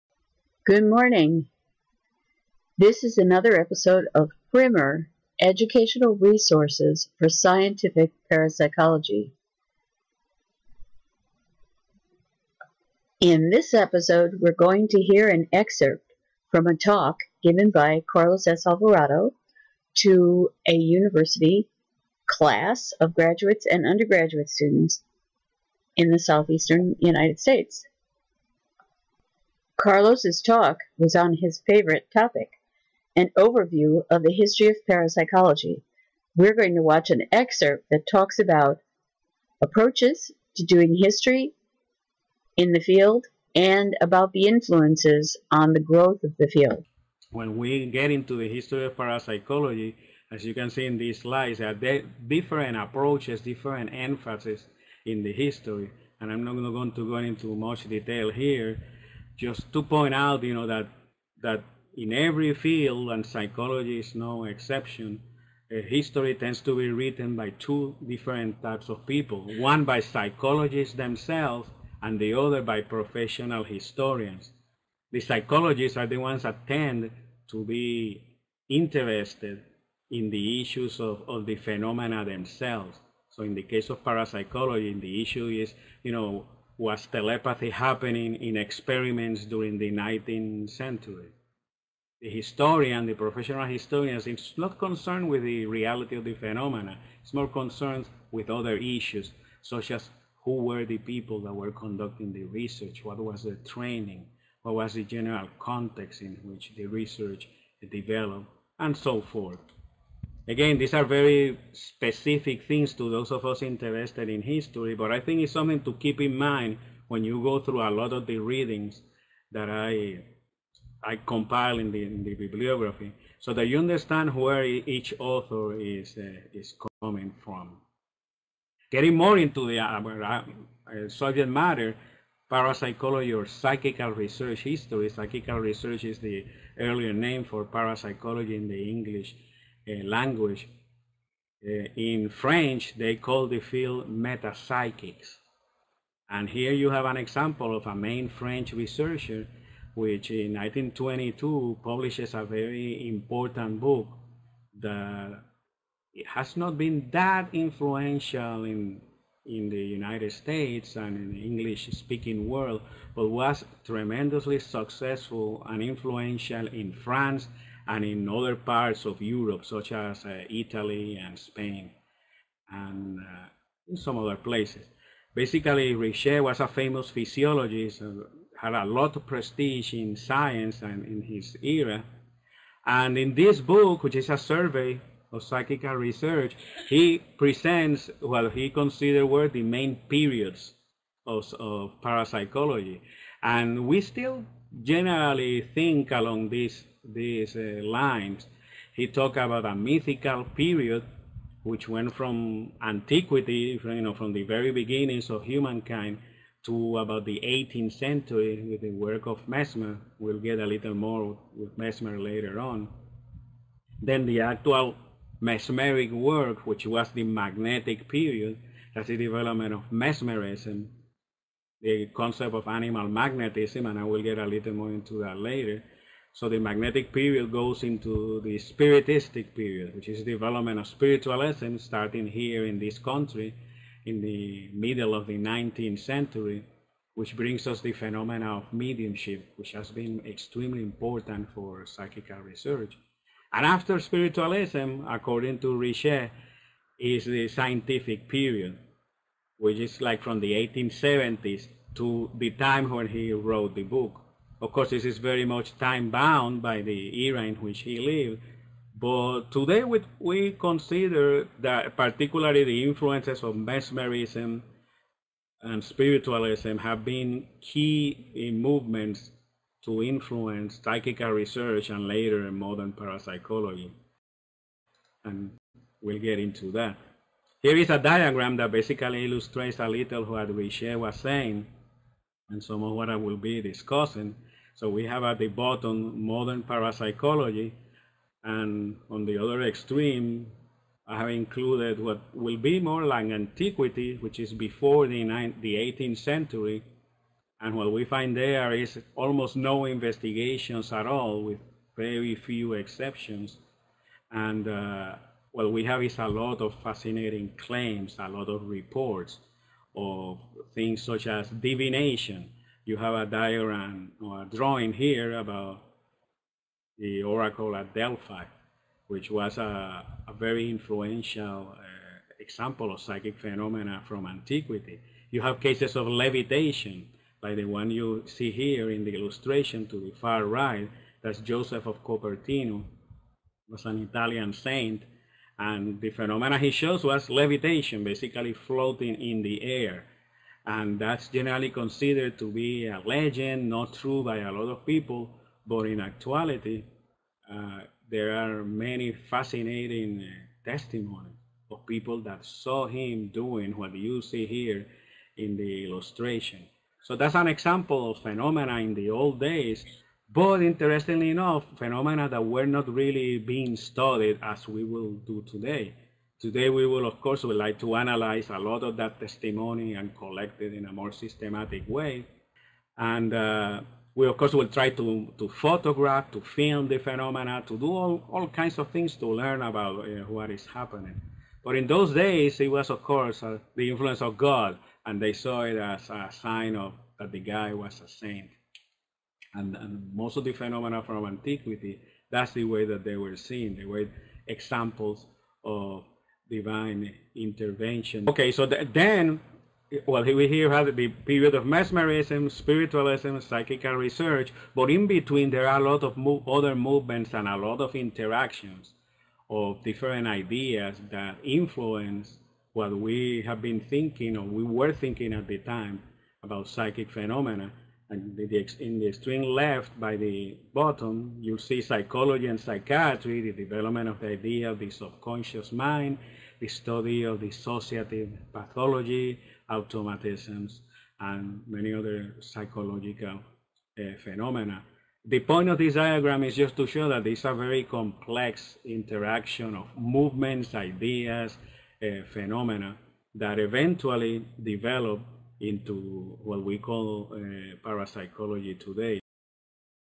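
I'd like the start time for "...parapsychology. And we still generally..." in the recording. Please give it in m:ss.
3:12.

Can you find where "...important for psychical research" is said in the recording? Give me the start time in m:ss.
4:00.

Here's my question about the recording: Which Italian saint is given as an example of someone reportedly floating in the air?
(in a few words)
Joseph of Copertino.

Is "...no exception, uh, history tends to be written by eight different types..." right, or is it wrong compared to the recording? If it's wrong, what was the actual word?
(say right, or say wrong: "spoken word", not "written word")
wrong: "two", not "eight".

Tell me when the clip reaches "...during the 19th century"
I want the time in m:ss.
1:29.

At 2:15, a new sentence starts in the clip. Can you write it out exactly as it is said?
Psychical research is the earlier name for parapsychology in the English uh, language.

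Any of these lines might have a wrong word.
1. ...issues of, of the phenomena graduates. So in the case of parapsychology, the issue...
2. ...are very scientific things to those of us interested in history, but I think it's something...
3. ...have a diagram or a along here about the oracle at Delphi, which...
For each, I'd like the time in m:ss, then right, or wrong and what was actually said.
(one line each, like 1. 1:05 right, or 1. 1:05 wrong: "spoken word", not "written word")
1. 1:20 wrong: "themselves", not "graduates"
2. 1:50 wrong: "specific", not "scientific"
3. 5:12 wrong: "drawing", not "along".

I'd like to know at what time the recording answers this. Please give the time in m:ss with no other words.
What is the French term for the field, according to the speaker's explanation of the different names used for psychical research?
2:24.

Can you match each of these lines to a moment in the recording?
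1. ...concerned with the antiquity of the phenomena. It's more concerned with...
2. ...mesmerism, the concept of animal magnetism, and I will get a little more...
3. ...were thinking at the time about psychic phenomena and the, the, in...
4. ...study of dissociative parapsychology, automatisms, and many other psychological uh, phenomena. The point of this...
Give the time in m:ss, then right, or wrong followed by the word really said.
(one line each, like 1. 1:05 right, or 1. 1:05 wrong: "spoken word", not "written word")
1. 1:34 wrong: "reality", not "antiquity"
2. 3:39 right
3. 6:54 right
4. 7:06 wrong: "pathology", not "parapsychology".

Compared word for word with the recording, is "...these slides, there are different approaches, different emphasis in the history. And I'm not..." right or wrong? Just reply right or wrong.
right.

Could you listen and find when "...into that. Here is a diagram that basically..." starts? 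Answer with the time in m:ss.
4:36.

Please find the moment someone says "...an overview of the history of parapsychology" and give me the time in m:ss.
0:33.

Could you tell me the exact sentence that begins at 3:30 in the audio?
We'll get a little more with Mesmer later on.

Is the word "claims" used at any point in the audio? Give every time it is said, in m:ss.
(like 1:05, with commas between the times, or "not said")
5:07.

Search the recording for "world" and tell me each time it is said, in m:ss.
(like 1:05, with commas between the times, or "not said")
2:42.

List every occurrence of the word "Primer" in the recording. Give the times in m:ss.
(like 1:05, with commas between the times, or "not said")
0:04.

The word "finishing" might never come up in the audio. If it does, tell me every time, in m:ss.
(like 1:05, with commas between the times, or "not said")
not said.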